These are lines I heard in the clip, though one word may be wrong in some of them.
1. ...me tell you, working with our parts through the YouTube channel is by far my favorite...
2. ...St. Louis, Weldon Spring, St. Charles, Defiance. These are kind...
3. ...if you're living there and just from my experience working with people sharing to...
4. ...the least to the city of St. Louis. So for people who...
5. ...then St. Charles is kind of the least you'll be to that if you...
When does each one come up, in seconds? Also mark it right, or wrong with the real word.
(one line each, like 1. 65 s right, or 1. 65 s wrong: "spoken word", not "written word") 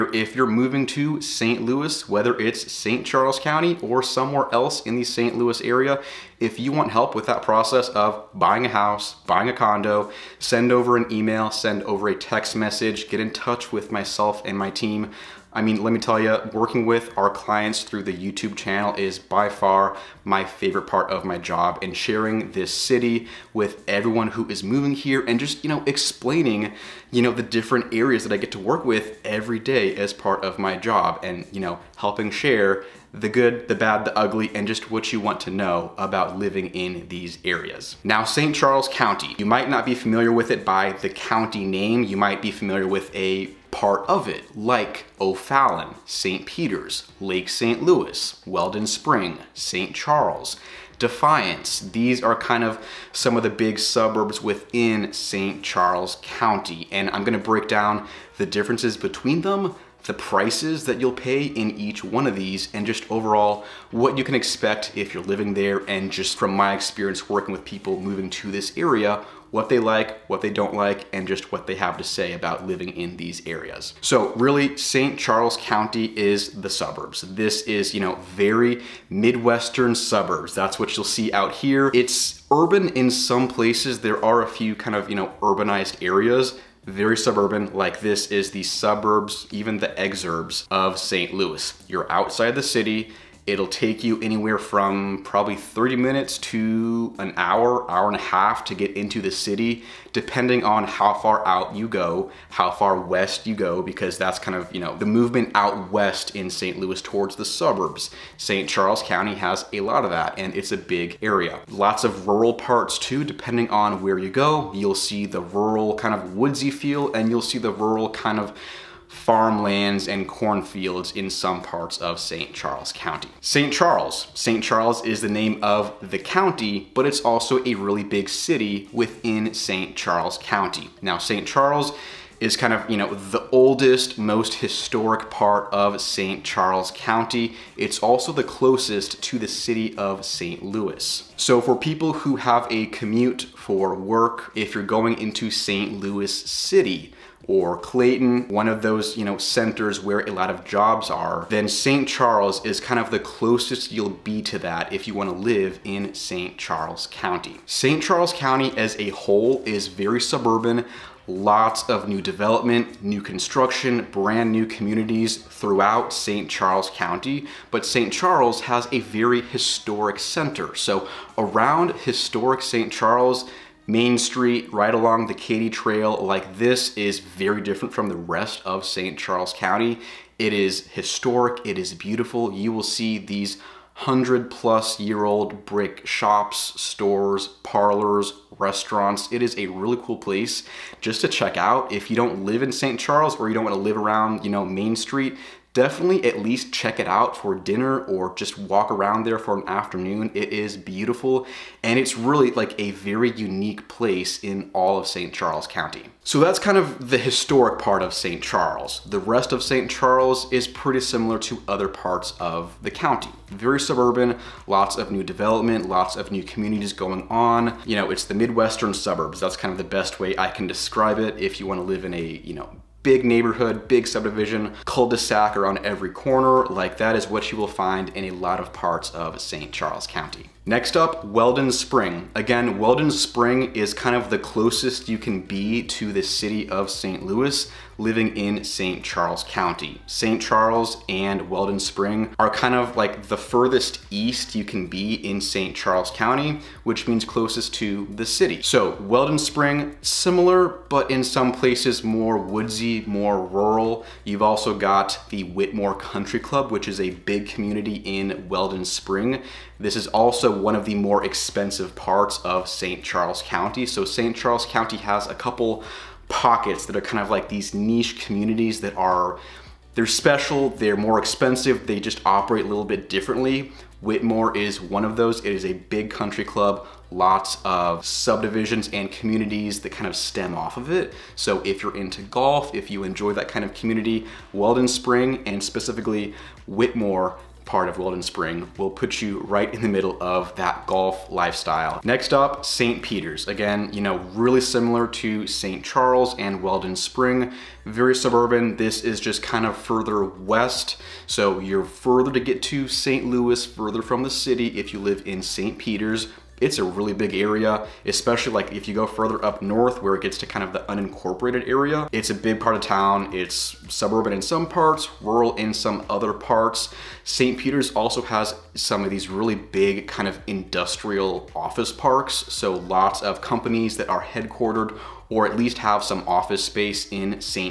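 1. 15 s wrong: "clients", not "parts"
2. 47 s right
3. 64 s wrong: "moving", not "sharing"
4. 138 s wrong: "closest", not "least"
5. 151 s wrong: "closest", not "least".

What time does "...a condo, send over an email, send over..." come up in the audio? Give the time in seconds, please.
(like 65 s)
9 s.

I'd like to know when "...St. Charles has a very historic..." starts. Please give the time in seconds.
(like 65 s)
167 s.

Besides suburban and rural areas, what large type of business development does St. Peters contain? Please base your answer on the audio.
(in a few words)
industrial office parks.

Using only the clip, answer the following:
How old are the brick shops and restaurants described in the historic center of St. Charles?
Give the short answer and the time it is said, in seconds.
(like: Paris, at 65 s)
100+ years old, at 183 s.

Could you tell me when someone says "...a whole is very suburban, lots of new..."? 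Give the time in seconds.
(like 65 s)
158 s.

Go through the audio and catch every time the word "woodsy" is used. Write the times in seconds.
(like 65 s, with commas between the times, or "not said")
116 s, 252 s.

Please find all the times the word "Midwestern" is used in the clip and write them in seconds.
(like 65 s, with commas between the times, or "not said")
79 s, 218 s.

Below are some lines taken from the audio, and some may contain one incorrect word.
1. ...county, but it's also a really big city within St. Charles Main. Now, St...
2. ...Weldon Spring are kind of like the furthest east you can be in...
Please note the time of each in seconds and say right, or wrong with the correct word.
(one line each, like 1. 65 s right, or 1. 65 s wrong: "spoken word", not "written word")
1. 126 s wrong: "County", not "Main"
2. 241 s right.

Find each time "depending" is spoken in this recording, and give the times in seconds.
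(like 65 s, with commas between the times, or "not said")
100 s, 113 s.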